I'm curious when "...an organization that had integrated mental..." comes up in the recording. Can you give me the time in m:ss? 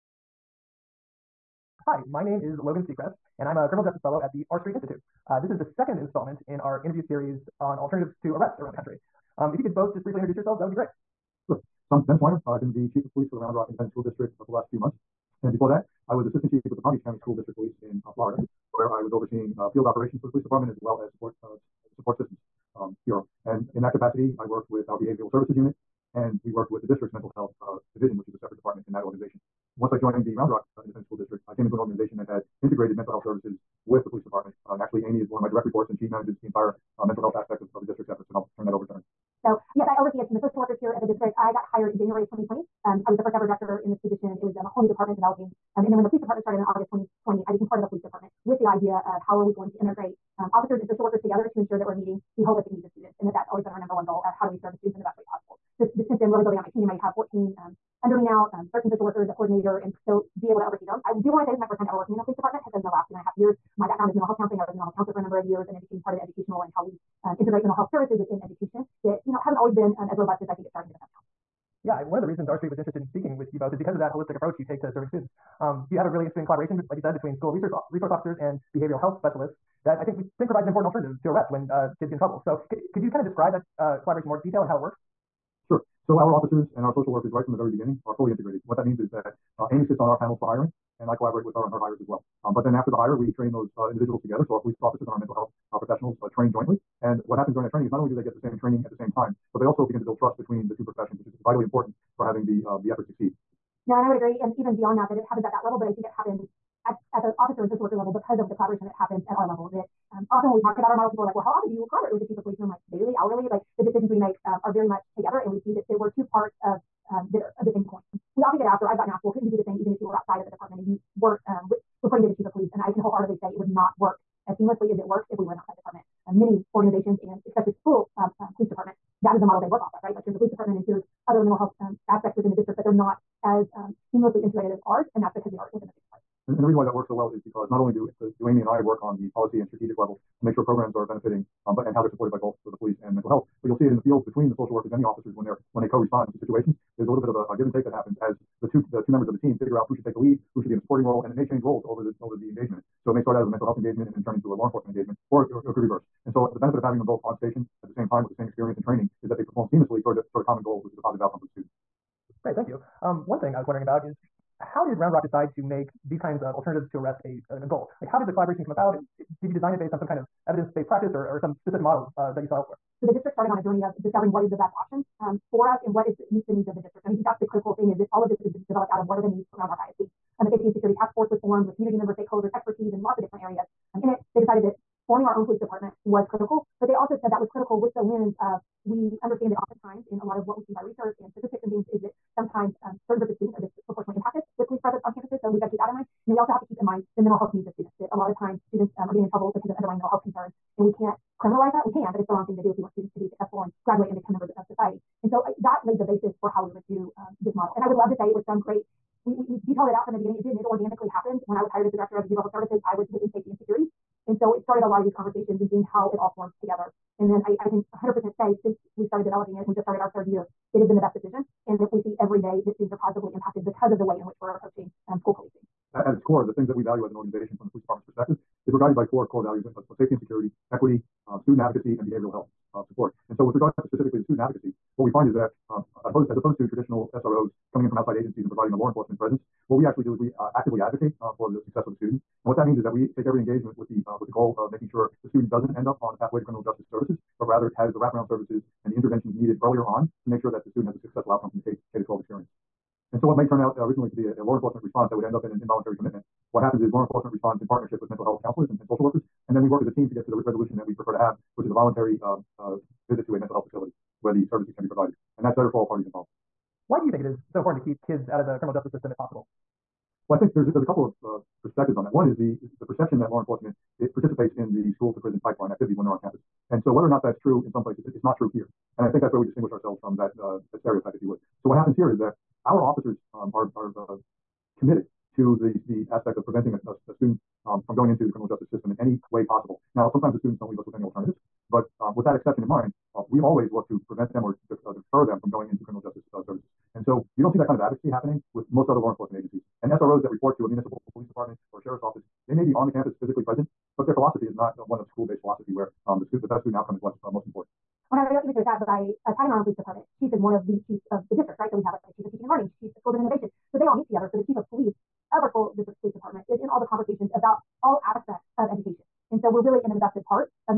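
0:31.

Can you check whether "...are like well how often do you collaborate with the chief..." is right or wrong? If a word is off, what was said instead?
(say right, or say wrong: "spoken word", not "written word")
right.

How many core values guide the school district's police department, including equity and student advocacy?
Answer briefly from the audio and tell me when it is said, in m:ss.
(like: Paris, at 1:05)
4, at 3:49.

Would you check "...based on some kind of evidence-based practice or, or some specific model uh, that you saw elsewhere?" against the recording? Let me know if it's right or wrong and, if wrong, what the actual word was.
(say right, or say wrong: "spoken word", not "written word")
right.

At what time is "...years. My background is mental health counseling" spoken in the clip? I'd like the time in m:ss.
1:03.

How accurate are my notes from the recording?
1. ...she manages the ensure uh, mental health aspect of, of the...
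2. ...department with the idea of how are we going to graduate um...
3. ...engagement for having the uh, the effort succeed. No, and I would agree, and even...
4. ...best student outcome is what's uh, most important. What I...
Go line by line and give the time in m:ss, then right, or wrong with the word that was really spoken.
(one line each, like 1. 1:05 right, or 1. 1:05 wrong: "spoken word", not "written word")
1. 0:35 wrong: "entire", not "ensure"
2. 0:48 wrong: "integrate", not "graduate"
3. 1:41 wrong: "important", not "engagement"
4. 5:06 right.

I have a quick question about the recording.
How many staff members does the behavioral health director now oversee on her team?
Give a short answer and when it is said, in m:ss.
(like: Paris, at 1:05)
14, at 0:57.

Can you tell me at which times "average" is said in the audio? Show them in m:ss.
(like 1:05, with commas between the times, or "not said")
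not said.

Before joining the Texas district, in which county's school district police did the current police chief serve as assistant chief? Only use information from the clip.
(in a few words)
Palm Beach County.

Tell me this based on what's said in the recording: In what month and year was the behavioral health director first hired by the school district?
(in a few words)
January 2020.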